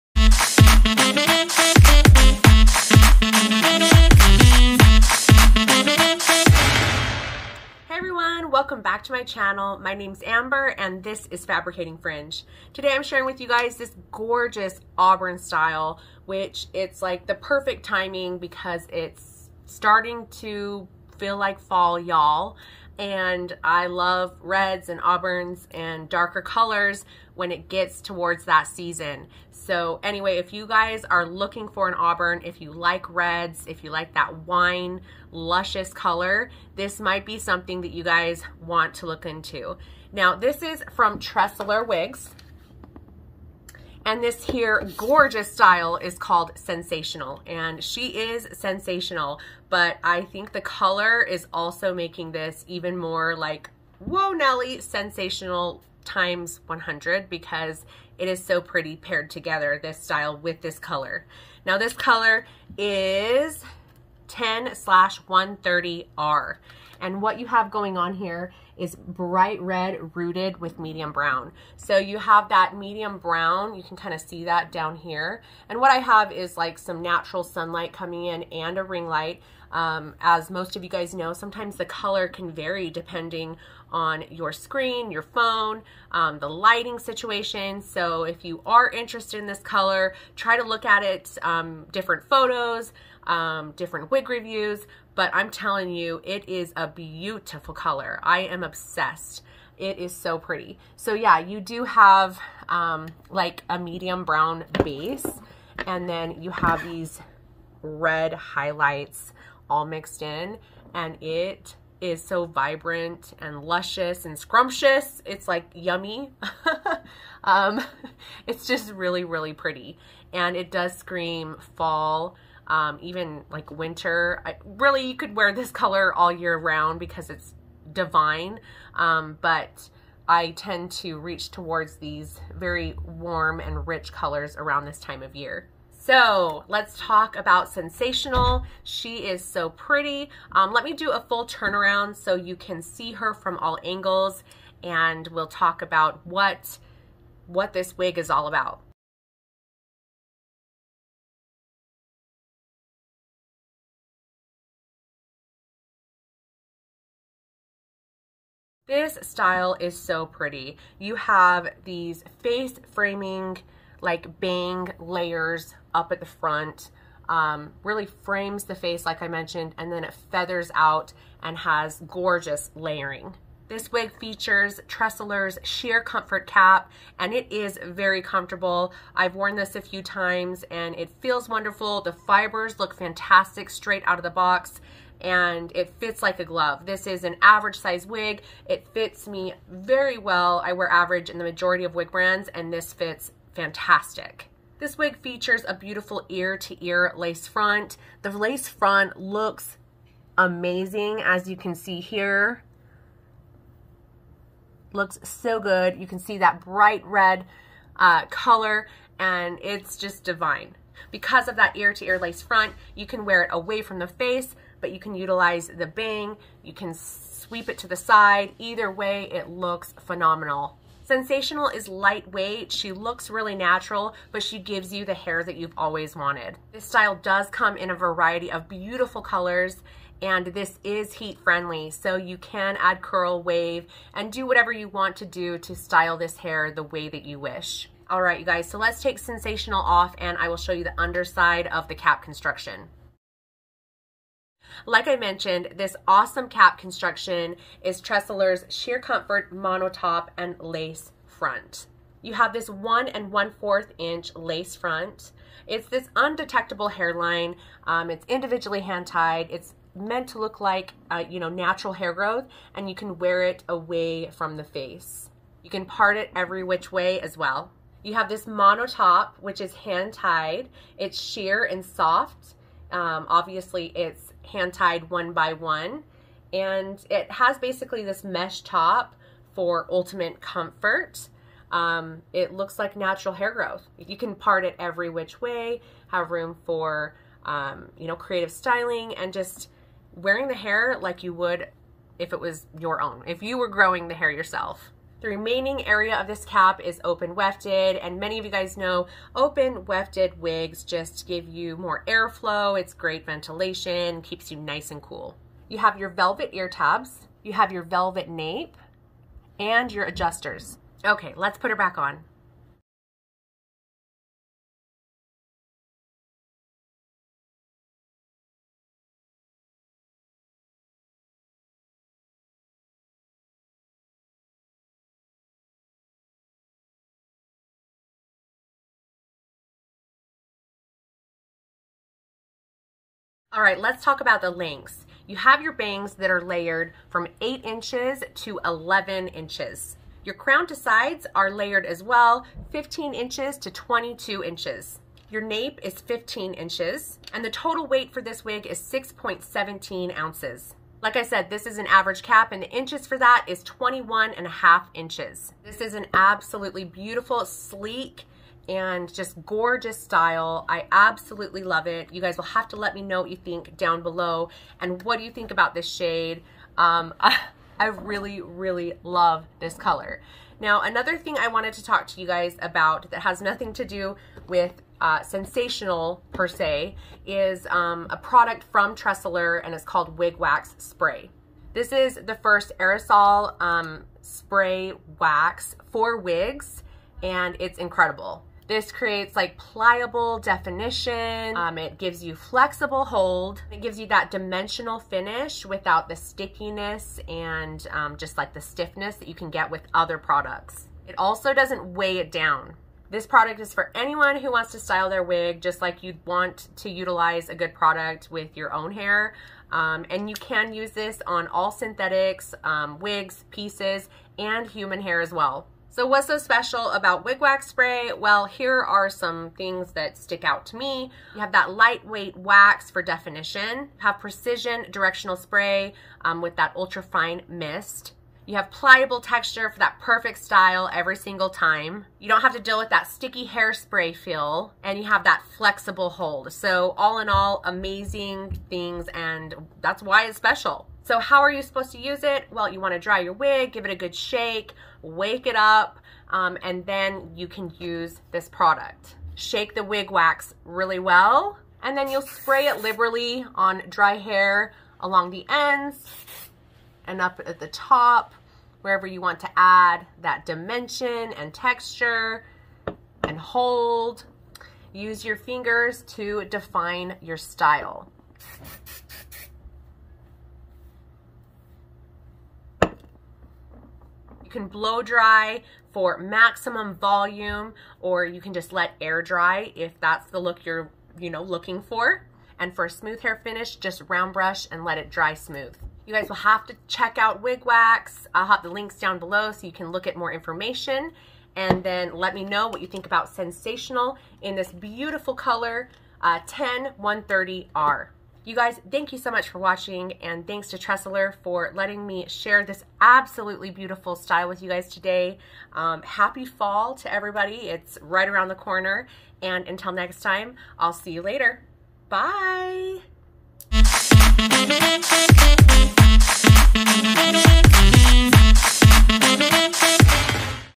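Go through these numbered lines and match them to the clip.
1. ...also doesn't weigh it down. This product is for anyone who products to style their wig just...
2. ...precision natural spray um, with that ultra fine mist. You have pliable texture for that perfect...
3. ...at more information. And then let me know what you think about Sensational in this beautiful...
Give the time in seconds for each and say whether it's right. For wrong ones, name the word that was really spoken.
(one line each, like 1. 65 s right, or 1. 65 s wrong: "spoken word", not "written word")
1. 401 s wrong: "wants", not "products"
2. 424 s wrong: "directional", not "natural"
3. 490 s right.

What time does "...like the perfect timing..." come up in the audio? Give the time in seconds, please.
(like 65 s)
17 s.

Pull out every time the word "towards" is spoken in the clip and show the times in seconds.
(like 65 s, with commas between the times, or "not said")
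27 s, 131 s.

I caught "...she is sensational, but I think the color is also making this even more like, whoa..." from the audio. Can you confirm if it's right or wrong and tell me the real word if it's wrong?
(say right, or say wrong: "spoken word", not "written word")
right.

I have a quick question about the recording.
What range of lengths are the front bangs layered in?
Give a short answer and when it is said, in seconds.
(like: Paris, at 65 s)
8 to 11 inches, at 337 s.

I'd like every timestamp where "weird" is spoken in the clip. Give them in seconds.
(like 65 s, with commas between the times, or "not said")
not said.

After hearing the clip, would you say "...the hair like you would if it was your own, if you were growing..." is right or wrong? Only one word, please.
right.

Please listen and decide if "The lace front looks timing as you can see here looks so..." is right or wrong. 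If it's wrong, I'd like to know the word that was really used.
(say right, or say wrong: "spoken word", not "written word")
wrong: "amazing", not "timing".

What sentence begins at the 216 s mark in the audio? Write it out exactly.
You can sweep it to the side.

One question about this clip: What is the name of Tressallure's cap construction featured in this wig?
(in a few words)
Sheer Comfort Cap.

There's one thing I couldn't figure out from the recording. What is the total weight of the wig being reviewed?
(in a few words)
6.17 ounces.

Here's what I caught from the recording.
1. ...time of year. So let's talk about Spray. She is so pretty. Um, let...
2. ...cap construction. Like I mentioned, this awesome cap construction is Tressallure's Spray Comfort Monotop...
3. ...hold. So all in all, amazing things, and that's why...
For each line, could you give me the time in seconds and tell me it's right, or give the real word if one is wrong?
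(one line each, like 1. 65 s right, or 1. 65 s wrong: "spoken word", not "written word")
1. 134 s wrong: "Sensational", not "Spray"
2. 241 s wrong: "Sheer", not "Spray"
3. 436 s right.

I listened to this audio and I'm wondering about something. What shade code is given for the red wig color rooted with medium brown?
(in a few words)
10/130R.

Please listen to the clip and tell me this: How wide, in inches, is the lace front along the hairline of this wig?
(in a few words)
1 1/4 inch.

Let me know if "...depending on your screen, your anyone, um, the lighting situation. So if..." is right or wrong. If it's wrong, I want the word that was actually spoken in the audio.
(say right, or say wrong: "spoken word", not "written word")
wrong: "phone", not "anyone".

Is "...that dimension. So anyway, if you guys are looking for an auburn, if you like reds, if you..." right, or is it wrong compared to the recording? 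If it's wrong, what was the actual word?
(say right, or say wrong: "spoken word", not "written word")
wrong: "season", not "dimension".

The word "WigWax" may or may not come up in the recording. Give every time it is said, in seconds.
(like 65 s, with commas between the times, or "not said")
417 s, 487 s.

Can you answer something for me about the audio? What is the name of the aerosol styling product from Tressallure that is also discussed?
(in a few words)
Wig Wax Spray.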